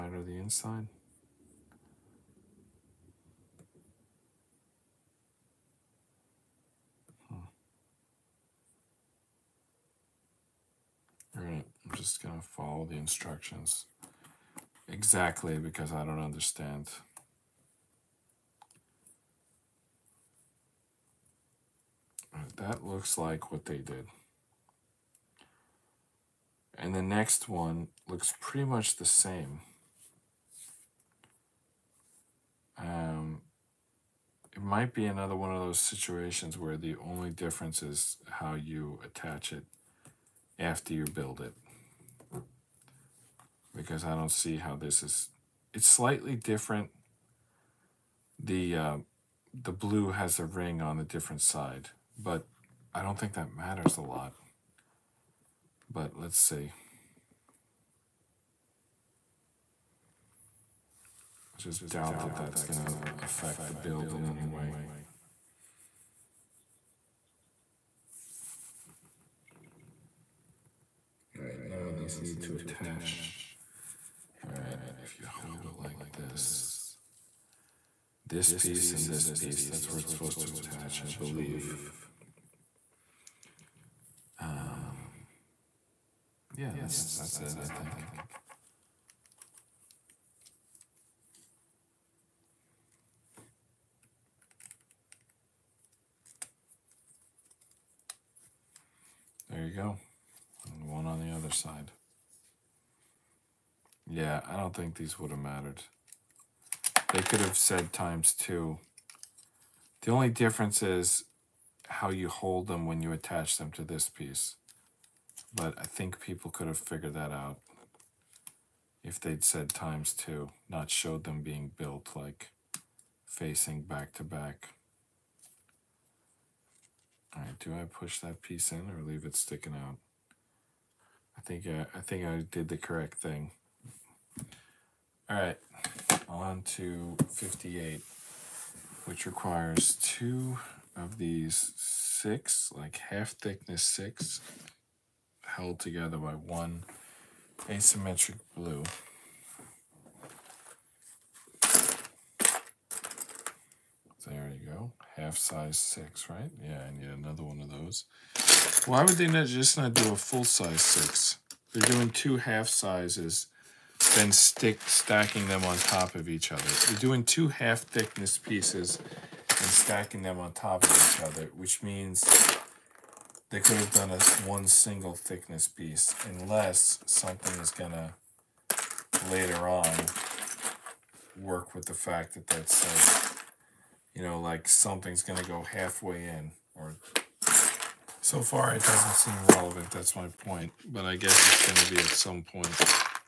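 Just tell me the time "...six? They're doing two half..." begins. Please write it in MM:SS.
02:40.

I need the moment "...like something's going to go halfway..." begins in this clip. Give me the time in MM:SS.
03:04.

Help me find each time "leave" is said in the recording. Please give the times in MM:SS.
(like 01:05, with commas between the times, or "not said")
02:09.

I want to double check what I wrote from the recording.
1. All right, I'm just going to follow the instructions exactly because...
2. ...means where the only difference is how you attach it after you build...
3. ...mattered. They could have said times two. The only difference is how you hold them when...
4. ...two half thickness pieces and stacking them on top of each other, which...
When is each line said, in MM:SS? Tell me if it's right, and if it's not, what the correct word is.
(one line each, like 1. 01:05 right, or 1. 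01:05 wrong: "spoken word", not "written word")
1. 00:11 right
2. 00:35 wrong: "situations", not "means"
3. 01:45 right
4. 02:47 right.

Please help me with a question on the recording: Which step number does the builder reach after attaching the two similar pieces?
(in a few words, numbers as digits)
58.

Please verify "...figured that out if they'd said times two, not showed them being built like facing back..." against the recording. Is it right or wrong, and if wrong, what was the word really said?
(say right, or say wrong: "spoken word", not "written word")
right.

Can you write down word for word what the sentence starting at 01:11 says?
All right, now these need to attach.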